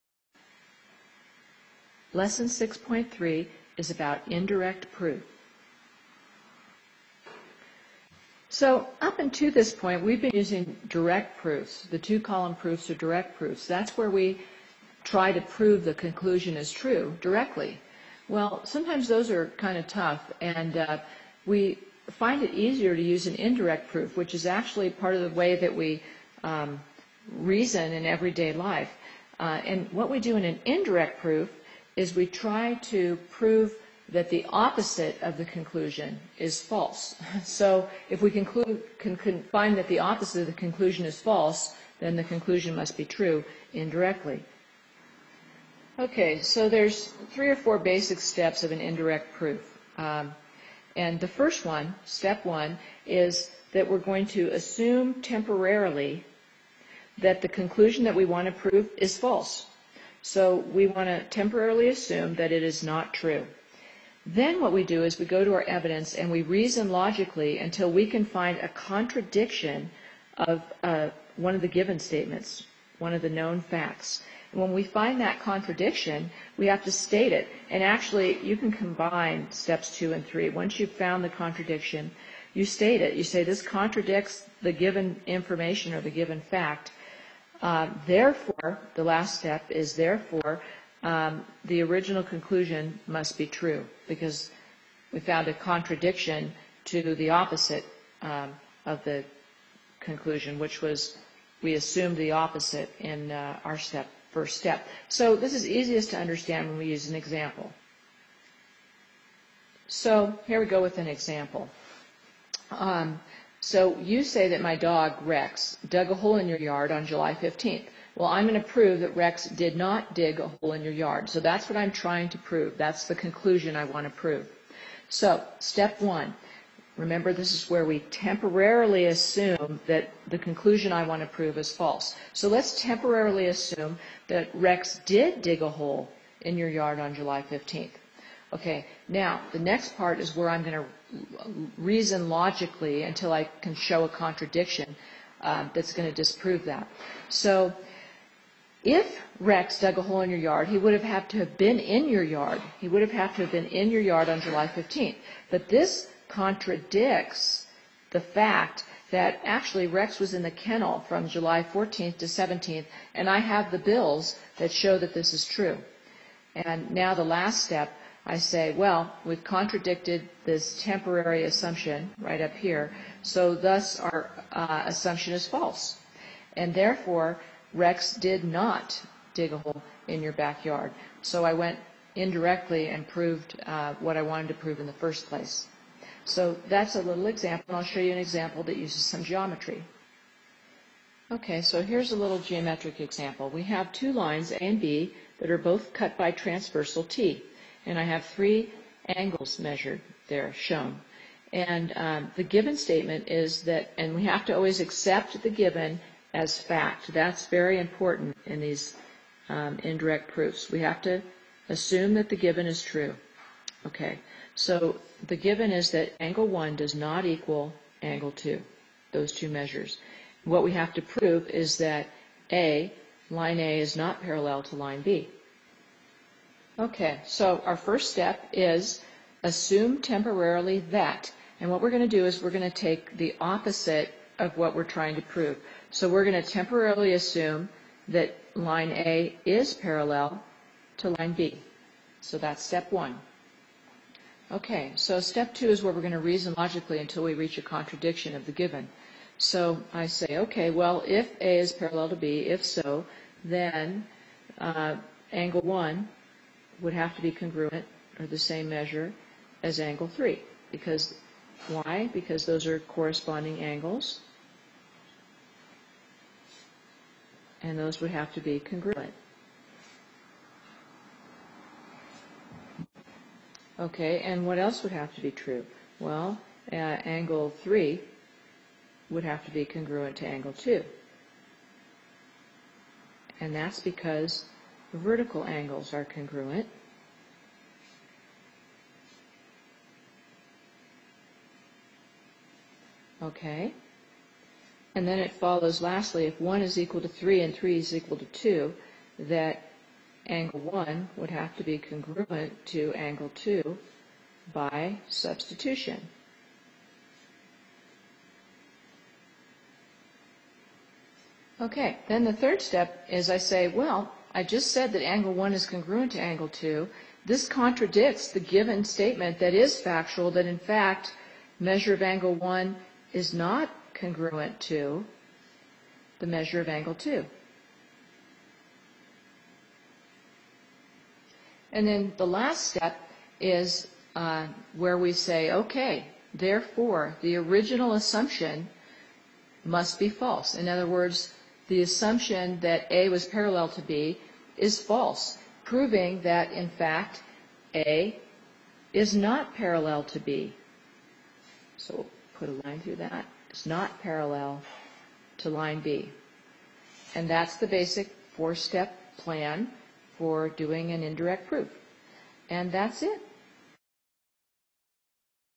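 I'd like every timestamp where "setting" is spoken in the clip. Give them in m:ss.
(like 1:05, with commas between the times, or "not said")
not said.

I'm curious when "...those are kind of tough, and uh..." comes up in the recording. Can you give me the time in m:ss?
0:19.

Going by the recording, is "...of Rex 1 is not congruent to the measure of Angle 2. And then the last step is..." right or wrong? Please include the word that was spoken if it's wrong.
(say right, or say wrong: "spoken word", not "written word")
wrong: "Angle", not "Rex".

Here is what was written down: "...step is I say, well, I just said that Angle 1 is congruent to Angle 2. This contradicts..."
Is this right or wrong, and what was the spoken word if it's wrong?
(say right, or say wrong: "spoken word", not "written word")
right.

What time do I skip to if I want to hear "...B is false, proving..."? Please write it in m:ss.
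5:43.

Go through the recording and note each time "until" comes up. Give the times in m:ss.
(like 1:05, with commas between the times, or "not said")
0:09, 1:07, 2:23, 4:06.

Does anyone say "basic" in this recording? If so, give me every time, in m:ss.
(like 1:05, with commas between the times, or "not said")
0:47, 5:57.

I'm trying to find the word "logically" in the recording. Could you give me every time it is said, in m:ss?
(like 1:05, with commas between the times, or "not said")
1:06, 2:22, 4:06.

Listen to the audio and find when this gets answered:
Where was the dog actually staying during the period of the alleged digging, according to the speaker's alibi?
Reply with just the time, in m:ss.
2:40.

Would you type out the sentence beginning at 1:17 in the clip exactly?
And actually, you can combine steps two and three.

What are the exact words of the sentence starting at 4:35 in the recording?
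Well, uh, angle 3 would have to be congruent to angle 2.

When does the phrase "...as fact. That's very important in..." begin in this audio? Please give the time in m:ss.
3:26.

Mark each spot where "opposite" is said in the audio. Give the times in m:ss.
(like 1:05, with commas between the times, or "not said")
0:34, 0:39, 1:37, 1:42, 3:53.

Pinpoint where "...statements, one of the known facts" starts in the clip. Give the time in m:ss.
1:11.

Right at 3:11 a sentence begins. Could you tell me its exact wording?
Okay, so here's a little geometric example.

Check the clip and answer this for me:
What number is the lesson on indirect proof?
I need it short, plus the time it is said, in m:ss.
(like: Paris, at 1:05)
6.3, at 0:02.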